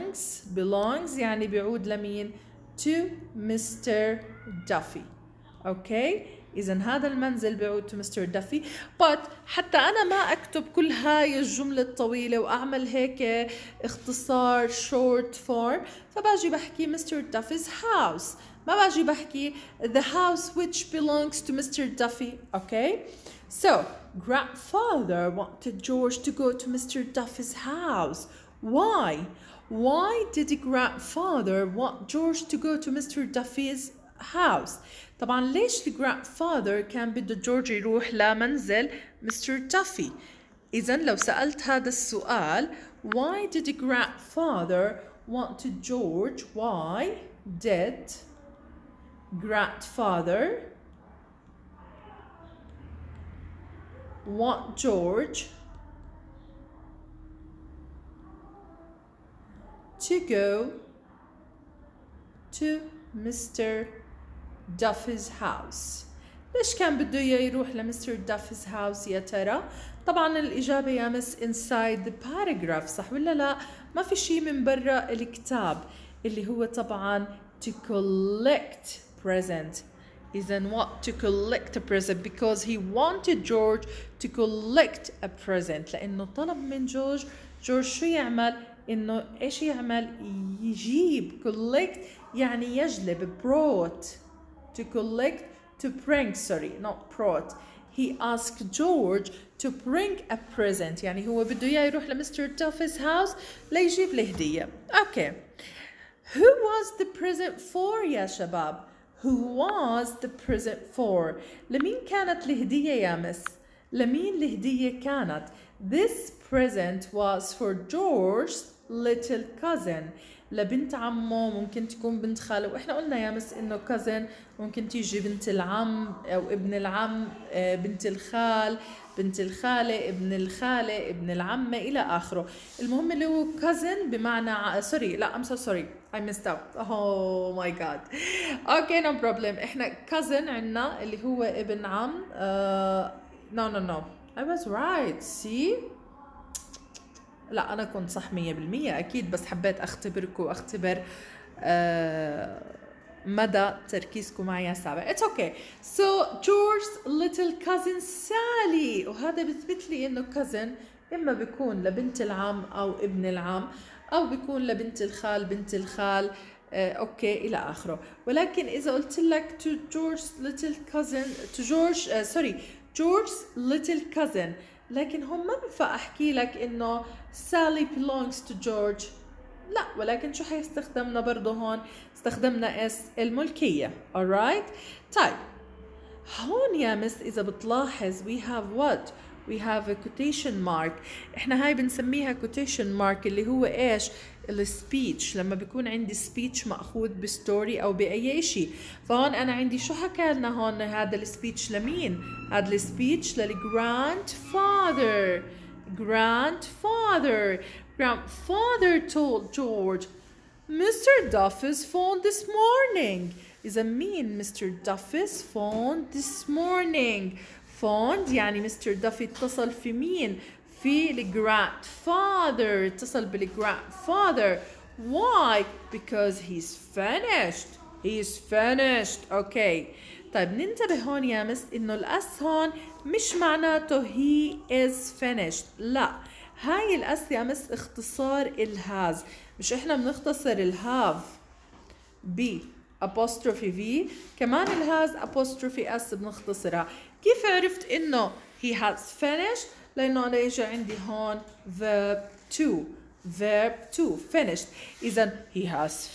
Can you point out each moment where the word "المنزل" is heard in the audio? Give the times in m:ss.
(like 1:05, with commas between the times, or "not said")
0:07.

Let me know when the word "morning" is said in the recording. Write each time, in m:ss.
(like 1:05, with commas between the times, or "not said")
3:32, 3:36.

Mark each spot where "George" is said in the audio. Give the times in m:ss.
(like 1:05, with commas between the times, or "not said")
0:25, 0:32, 0:45, 0:54, 1:23, 1:38, 1:57.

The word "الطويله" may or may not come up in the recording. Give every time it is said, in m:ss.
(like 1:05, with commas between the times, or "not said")
0:11.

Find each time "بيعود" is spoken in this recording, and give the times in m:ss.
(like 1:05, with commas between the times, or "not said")
0:01, 0:07.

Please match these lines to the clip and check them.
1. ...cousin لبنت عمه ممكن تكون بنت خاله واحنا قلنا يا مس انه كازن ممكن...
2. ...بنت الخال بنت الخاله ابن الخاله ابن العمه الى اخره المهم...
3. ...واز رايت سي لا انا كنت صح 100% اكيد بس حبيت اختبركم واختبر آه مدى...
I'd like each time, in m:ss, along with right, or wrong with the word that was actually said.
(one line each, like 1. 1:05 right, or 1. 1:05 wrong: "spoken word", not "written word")
1. 1:59 right
2. 2:07 right
3. 2:24 right.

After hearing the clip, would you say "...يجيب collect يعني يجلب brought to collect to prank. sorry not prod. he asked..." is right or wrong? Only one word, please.
right.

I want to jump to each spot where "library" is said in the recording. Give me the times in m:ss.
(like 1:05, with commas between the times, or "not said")
not said.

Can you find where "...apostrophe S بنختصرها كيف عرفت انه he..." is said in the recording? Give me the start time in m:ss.
4:05.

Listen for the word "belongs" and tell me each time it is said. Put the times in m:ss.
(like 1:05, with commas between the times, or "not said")
0:00, 0:20, 2:57.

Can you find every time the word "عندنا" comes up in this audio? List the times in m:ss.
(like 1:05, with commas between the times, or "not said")
2:20.